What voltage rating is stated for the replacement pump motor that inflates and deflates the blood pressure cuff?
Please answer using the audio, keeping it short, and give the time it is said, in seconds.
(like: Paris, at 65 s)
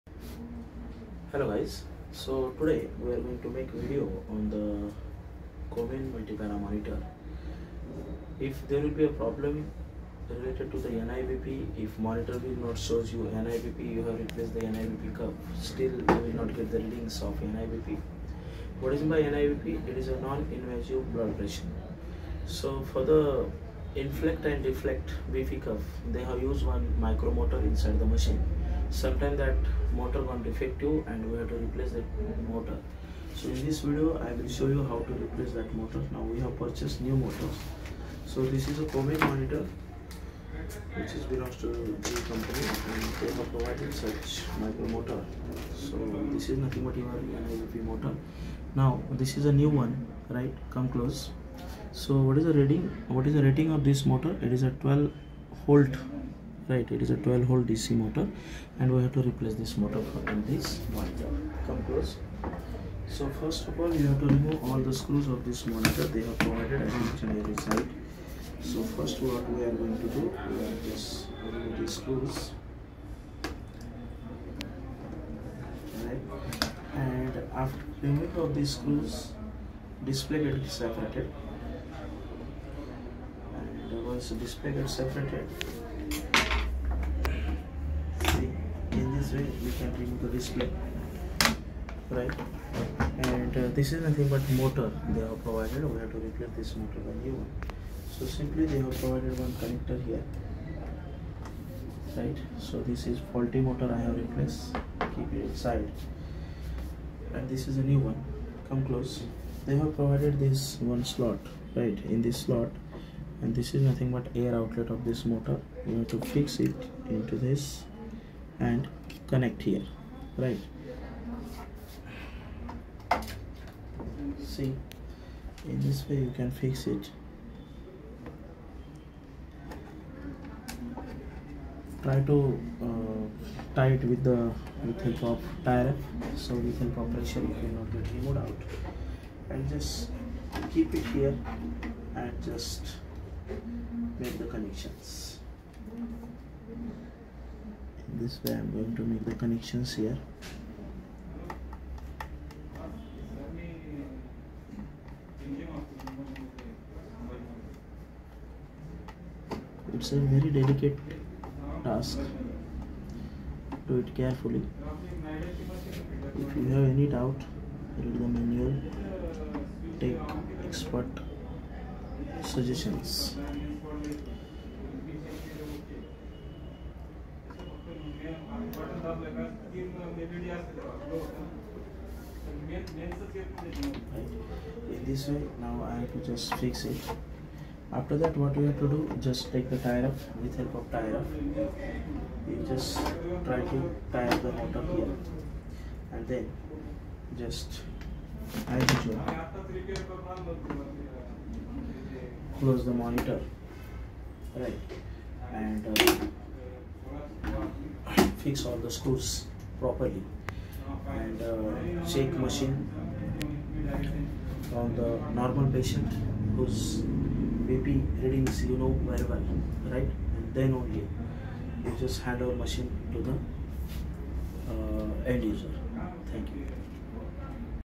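12 volt, at 54 s.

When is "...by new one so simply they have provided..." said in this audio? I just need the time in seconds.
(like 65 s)
97 s.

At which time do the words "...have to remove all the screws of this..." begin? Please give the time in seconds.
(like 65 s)
64 s.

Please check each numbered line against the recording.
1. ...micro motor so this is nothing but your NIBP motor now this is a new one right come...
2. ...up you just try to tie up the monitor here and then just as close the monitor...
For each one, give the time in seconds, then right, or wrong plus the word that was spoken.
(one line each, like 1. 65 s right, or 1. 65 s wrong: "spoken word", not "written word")
1. 44 s right
2. 191 s wrong: "motor", not "monitor".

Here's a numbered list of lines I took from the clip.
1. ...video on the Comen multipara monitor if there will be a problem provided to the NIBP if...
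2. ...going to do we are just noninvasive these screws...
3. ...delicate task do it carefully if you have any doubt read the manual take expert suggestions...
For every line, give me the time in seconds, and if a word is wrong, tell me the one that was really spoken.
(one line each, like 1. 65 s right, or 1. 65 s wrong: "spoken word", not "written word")
1. 3 s wrong: "related", not "provided"
2. 69 s wrong: "remove", not "noninvasive"
3. 160 s right.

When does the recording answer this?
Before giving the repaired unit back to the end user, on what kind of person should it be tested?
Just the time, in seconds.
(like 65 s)
215 s.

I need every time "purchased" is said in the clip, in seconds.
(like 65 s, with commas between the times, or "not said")
36 s.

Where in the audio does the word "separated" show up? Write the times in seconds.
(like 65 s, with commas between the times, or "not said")
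80 s, 85 s.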